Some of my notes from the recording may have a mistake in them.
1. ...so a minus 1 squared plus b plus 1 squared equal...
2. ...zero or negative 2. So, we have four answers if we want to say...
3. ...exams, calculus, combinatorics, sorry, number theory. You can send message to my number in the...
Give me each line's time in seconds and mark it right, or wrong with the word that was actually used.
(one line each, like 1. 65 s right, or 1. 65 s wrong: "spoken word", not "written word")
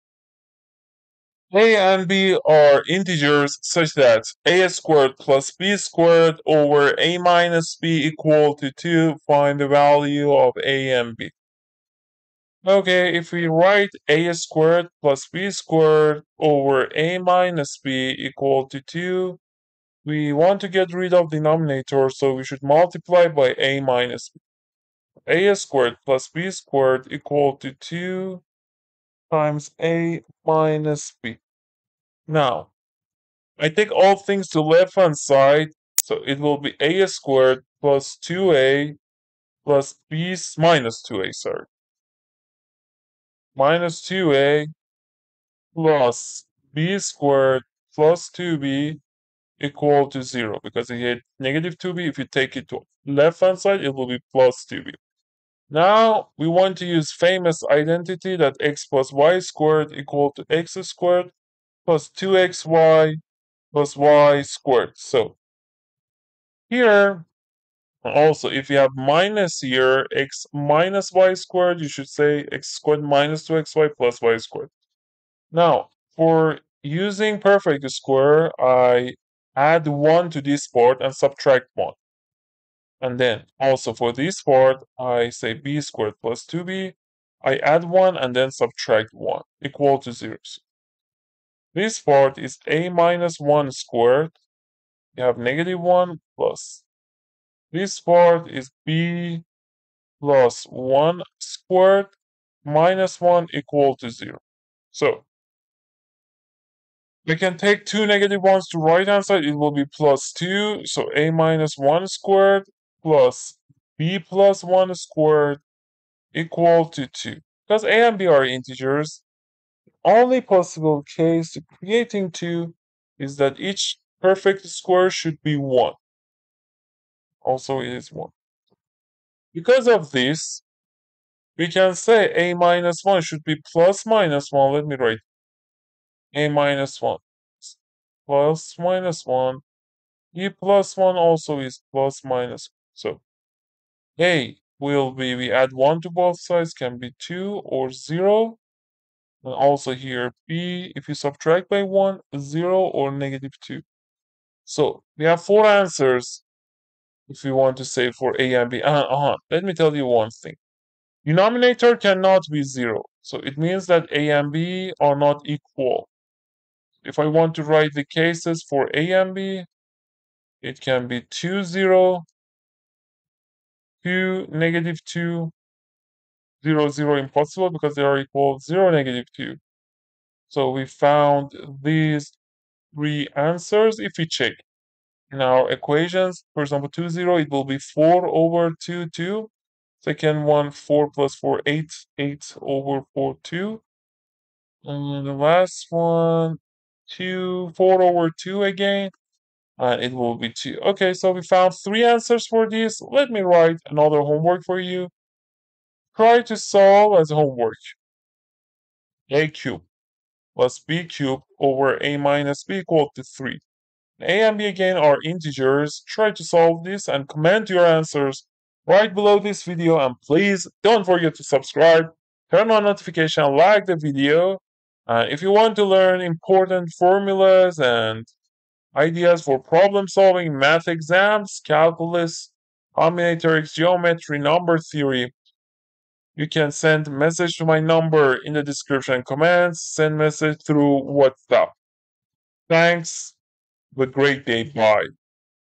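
1. 110 s right
2. 152 s right
3. 230 s wrong: "geometry", not "sorry".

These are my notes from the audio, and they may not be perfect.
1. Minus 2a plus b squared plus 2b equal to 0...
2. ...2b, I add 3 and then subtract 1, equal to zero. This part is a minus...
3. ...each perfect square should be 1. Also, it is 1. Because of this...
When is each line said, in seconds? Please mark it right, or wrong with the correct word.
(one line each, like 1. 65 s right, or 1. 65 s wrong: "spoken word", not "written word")
1. 43 s right
2. 86 s wrong: "1", not "3"
3. 123 s right.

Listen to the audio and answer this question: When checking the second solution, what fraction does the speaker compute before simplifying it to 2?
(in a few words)
8 over 4.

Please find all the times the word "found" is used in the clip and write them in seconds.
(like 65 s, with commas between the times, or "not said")
180 s, 201 s.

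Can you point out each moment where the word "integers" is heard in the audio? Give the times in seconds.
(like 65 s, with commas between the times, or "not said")
2 s, 118 s, 215 s.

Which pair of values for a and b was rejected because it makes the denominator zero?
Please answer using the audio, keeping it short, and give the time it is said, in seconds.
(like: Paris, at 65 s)
0, 0, at 176 s.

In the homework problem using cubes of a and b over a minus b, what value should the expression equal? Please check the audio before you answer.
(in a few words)
3.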